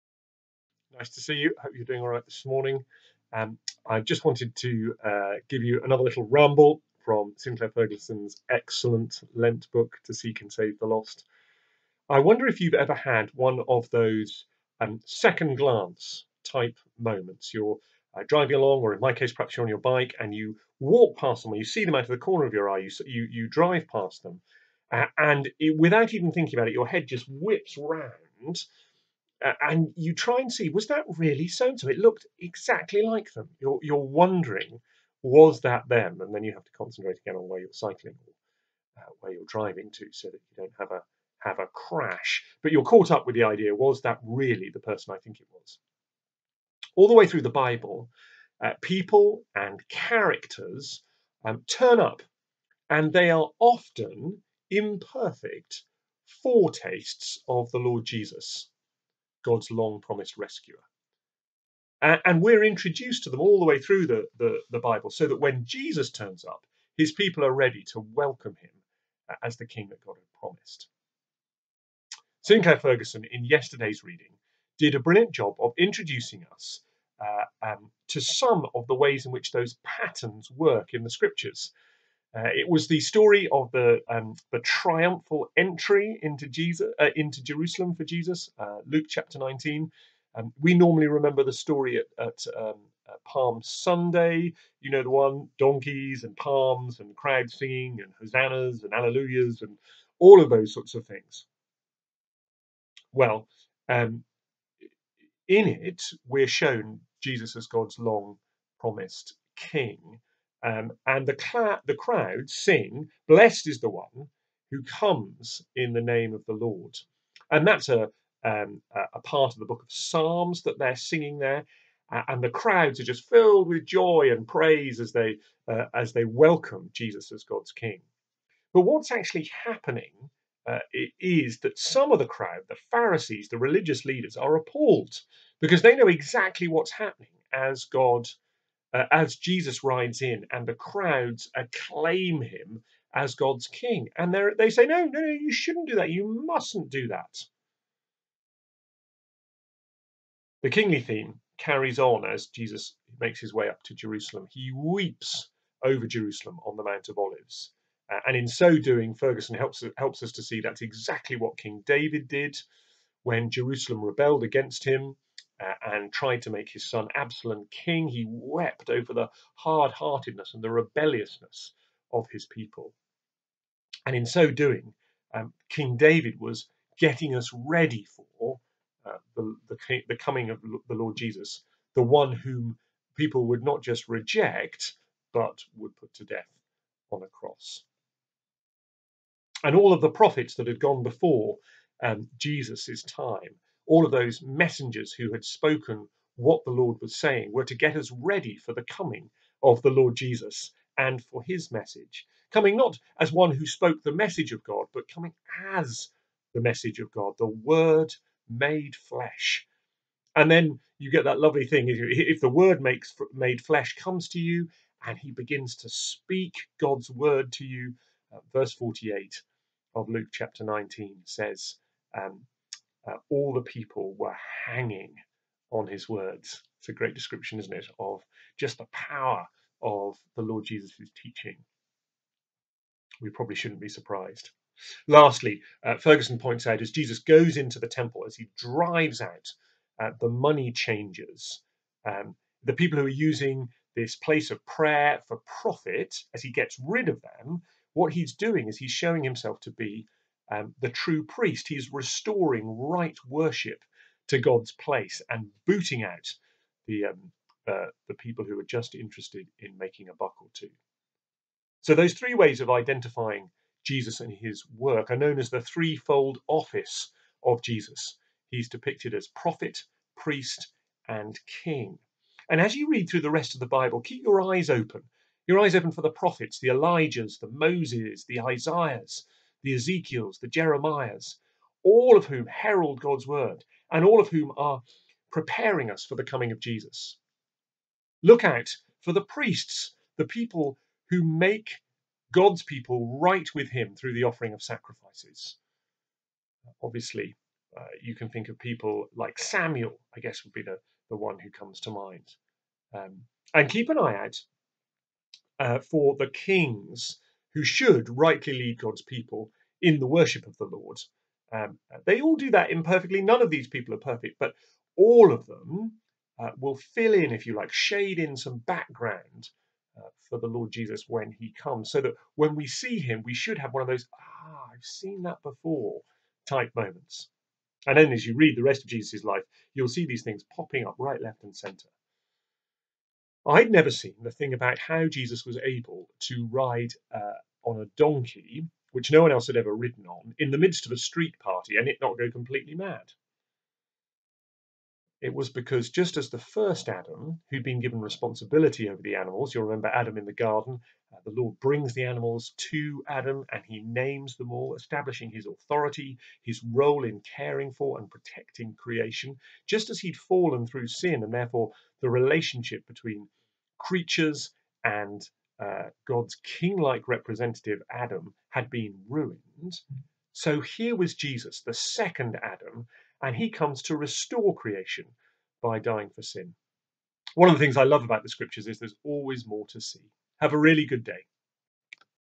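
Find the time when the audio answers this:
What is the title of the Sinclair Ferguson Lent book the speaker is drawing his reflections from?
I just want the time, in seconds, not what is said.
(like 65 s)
10 s.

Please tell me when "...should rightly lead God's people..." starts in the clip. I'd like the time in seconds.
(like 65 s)
307 s.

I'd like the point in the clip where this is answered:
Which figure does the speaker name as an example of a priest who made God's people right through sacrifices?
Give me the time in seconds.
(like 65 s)
299 s.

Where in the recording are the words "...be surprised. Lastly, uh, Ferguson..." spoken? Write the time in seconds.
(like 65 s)
233 s.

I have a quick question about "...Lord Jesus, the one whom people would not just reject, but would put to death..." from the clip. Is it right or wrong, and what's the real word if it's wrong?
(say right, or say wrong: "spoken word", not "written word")
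right.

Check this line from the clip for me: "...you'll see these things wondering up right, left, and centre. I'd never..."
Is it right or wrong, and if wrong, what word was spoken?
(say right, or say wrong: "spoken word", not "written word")
wrong: "popping", not "wondering".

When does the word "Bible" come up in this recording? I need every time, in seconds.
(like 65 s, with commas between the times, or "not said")
47 s, 64 s, 273 s.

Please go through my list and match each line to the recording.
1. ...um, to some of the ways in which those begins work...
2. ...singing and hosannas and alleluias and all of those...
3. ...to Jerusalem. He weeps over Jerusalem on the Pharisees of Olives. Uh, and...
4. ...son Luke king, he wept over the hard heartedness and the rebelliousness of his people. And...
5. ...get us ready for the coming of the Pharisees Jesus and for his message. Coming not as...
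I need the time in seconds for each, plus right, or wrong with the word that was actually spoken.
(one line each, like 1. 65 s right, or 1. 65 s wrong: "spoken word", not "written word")
1. 77 s wrong: "patterns", not "begins"
2. 97 s right
3. 153 s wrong: "Mount", not "Pharisees"
4. 166 s wrong: "Absalom", not "Luke"
5. 197 s wrong: "Lord", not "Pharisees".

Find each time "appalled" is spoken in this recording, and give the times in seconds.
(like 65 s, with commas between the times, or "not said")
134 s.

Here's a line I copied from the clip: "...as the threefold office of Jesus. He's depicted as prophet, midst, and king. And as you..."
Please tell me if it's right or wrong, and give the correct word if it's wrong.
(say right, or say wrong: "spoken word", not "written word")
wrong: "priest", not "midst".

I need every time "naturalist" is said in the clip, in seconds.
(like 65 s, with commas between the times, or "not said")
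not said.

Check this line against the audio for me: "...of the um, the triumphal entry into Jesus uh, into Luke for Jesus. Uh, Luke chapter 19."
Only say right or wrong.
wrong.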